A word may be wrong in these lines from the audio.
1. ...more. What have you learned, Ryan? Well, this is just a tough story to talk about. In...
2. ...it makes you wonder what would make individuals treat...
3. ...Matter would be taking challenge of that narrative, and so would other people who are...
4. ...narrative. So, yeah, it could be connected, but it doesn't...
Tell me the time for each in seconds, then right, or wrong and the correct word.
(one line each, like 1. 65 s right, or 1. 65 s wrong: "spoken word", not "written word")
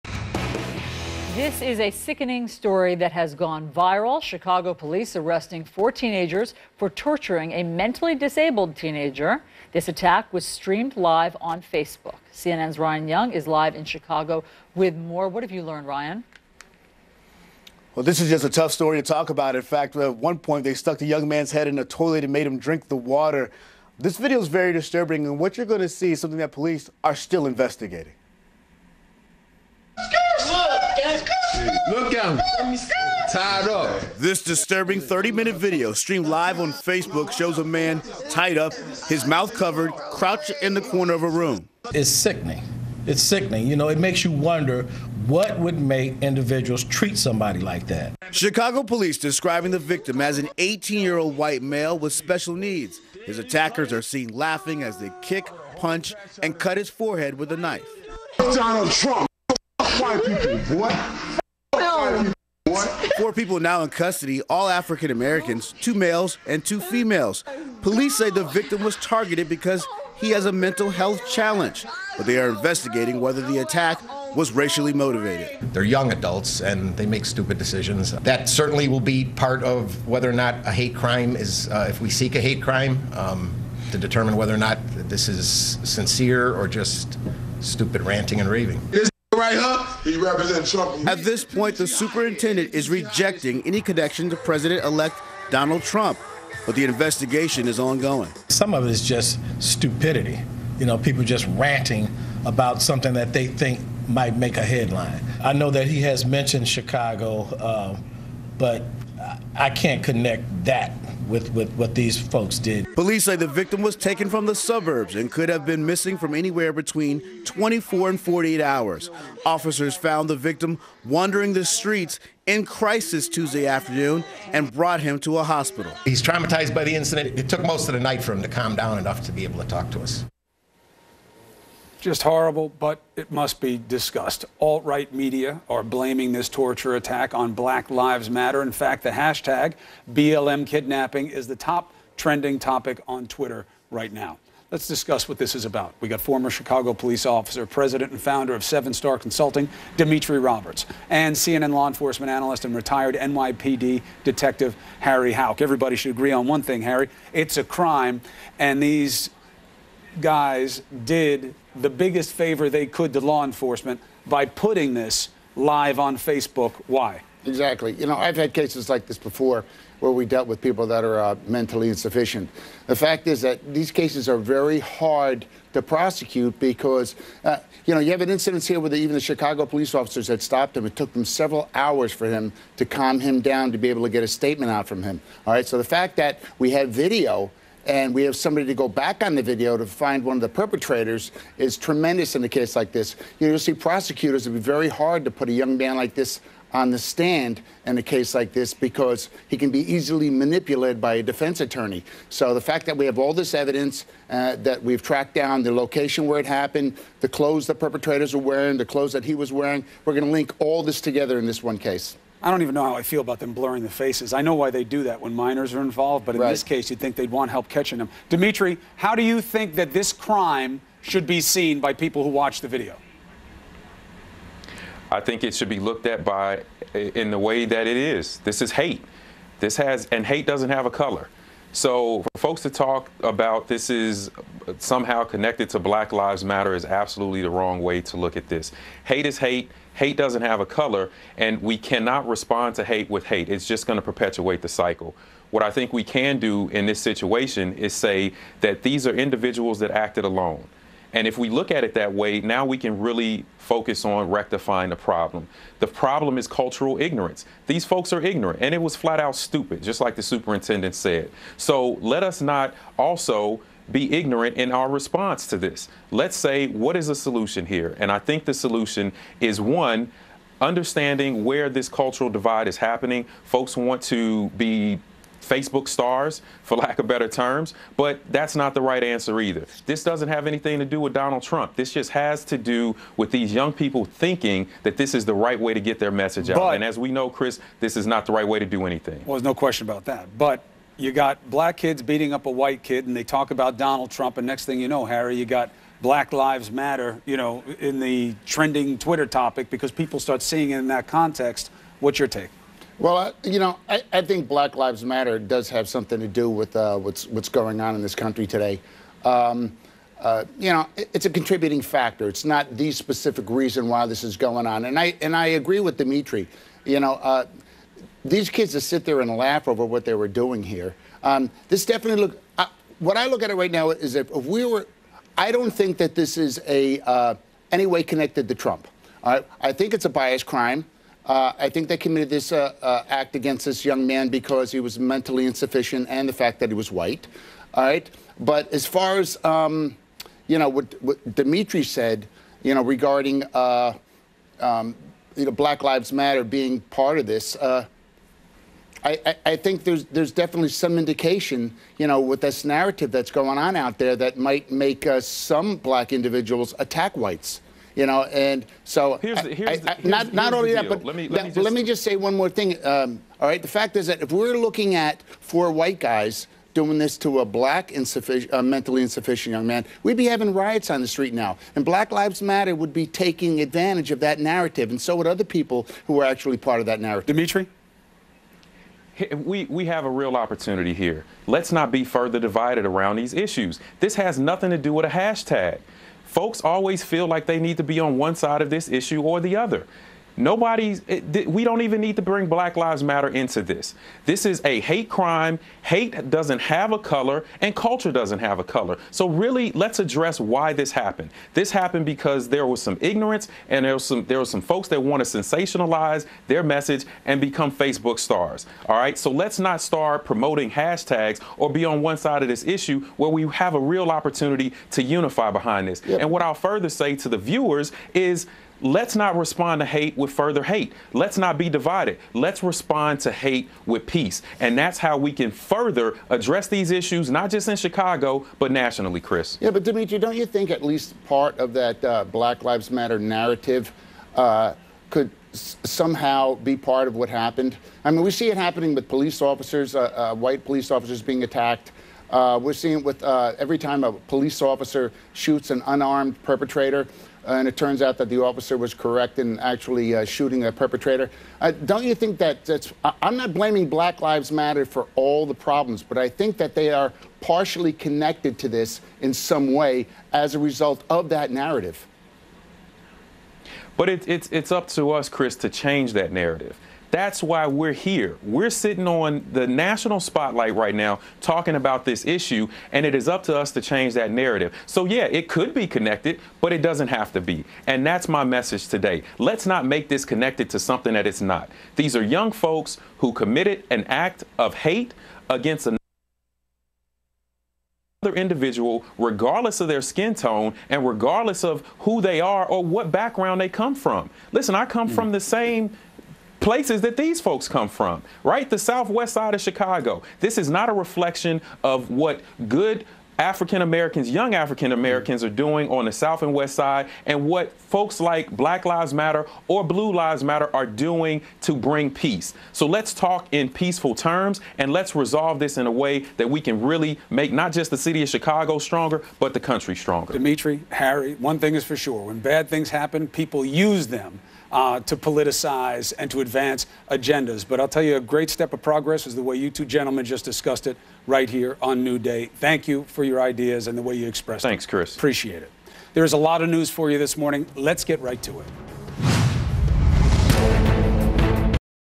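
1. 14 s right
2. 43 s right
3. 372 s wrong: "advantage", not "challenge"
4. 474 s right.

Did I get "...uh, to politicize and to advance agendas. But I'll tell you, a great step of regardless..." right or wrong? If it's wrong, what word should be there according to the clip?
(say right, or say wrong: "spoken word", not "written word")
wrong: "progress", not "regardless".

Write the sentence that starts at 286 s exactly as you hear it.
But, and as we know, Chris, this is not the right way to do anything.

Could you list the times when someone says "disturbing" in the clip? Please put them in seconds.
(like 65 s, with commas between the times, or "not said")
24 s, 34 s.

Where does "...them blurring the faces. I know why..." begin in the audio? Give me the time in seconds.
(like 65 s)
213 s.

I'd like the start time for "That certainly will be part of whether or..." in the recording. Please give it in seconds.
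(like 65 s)
78 s.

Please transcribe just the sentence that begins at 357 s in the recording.
You know, and so here's the, here's not not only that, but let me let, me, just...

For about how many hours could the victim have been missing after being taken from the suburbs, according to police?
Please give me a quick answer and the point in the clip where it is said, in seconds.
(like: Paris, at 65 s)
24 to 48 hours, at 116 s.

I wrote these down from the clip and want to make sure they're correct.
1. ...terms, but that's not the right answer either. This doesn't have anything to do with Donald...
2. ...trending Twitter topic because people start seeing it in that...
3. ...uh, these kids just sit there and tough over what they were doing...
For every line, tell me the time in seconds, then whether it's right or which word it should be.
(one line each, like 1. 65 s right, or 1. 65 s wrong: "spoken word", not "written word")
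1. 277 s right
2. 298 s right
3. 317 s wrong: "laugh", not "tough".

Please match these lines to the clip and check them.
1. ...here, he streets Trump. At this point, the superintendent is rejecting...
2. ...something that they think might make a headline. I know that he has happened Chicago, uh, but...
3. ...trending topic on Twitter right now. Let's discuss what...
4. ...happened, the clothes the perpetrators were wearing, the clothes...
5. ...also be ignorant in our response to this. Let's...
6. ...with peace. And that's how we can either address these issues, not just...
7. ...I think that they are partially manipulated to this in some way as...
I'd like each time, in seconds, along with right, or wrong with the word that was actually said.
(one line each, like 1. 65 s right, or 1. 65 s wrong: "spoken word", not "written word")
1. 90 s wrong: "represents", not "streets"
2. 102 s wrong: "mentioned", not "happened"
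3. 142 s right
4. 206 s right
5. 262 s right
6. 423 s wrong: "further", not "either"
7. 456 s wrong: "connected", not "manipulated".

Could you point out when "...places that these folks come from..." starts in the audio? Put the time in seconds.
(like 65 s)
496 s.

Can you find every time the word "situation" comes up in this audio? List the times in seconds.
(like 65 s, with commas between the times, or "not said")
246 s.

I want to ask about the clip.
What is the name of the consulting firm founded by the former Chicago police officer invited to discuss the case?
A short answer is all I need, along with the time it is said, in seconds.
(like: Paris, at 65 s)
Seven Star Consulting, at 148 s.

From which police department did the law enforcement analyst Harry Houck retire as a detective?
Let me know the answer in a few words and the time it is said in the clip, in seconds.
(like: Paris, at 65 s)
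NYPD, at 153 s.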